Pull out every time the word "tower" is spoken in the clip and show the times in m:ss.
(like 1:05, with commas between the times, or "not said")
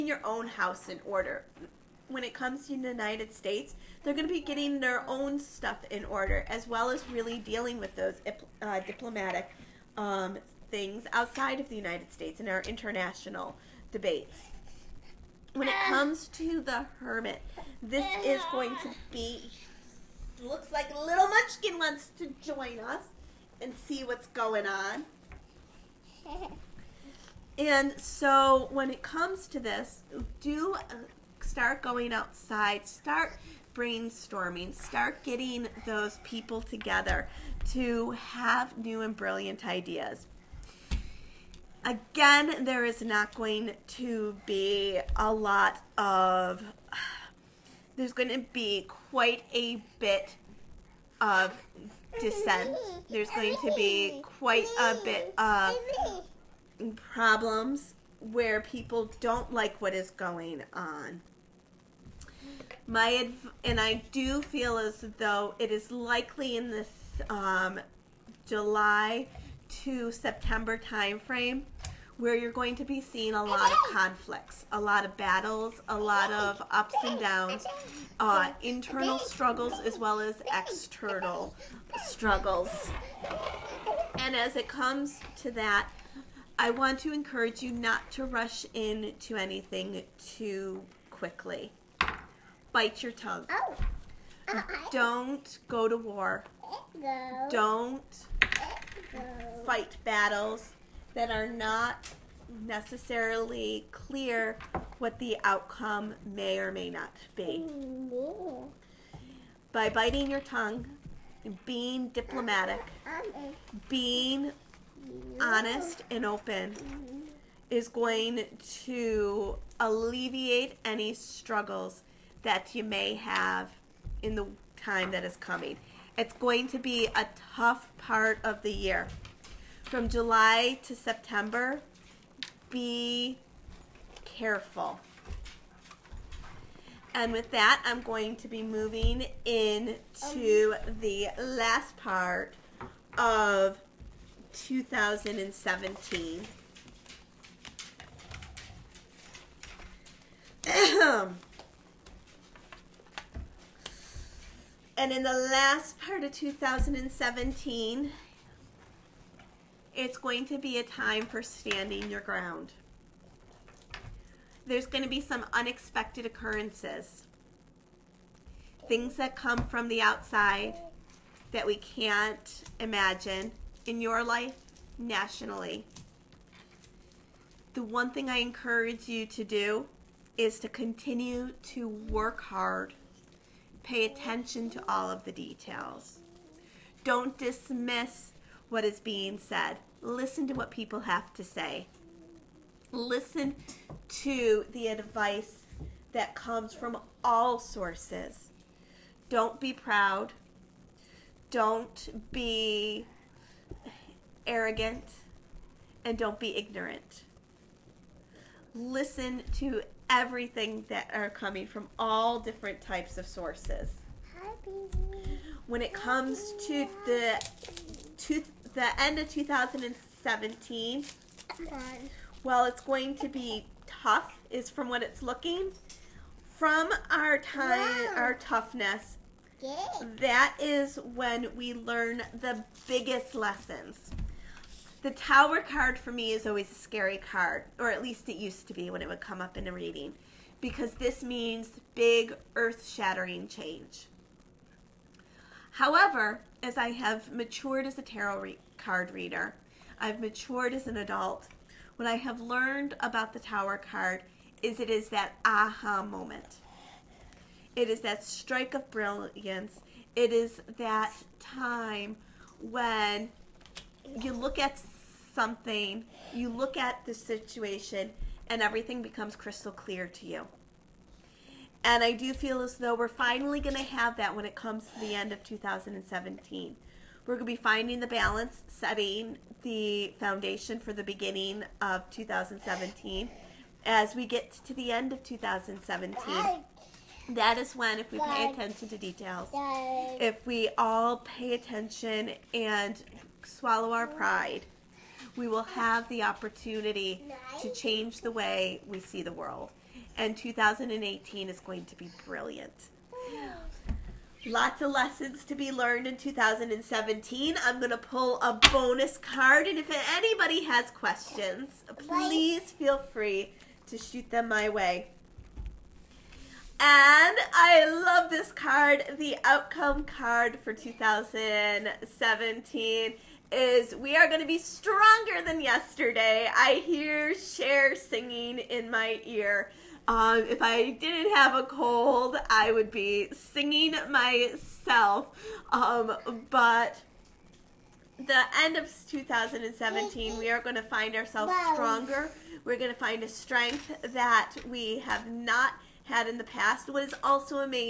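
3:55, 4:13.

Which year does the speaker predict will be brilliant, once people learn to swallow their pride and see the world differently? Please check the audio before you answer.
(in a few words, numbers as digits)
2018.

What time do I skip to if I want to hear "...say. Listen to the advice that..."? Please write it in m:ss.
3:11.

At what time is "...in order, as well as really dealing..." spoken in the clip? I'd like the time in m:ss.
0:05.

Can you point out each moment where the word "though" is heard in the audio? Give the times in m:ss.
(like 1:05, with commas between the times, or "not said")
1:05, 4:32.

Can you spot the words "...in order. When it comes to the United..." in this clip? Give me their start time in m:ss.
0:00.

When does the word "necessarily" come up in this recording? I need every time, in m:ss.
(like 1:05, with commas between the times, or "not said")
1:42.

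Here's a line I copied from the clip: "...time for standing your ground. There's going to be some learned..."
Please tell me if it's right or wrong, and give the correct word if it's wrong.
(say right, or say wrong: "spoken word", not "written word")
wrong: "unexpected", not "learned".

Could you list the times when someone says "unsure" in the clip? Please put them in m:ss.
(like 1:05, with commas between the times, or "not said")
not said.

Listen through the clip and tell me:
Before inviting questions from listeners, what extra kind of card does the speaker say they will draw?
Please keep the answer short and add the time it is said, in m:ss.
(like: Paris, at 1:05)
bonus card, at 5:08.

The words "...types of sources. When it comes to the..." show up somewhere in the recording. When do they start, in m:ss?
3:32.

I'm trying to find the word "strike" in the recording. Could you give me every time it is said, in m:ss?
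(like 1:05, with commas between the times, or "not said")
4:18.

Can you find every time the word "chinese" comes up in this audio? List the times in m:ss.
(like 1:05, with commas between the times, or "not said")
not said.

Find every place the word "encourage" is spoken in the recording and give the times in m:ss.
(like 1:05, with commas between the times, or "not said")
1:27, 2:58.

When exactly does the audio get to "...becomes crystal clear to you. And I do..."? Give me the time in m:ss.
4:29.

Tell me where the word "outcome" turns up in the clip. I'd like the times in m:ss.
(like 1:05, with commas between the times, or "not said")
1:45, 5:19.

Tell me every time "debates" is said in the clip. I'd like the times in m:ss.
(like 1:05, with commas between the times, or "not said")
0:13.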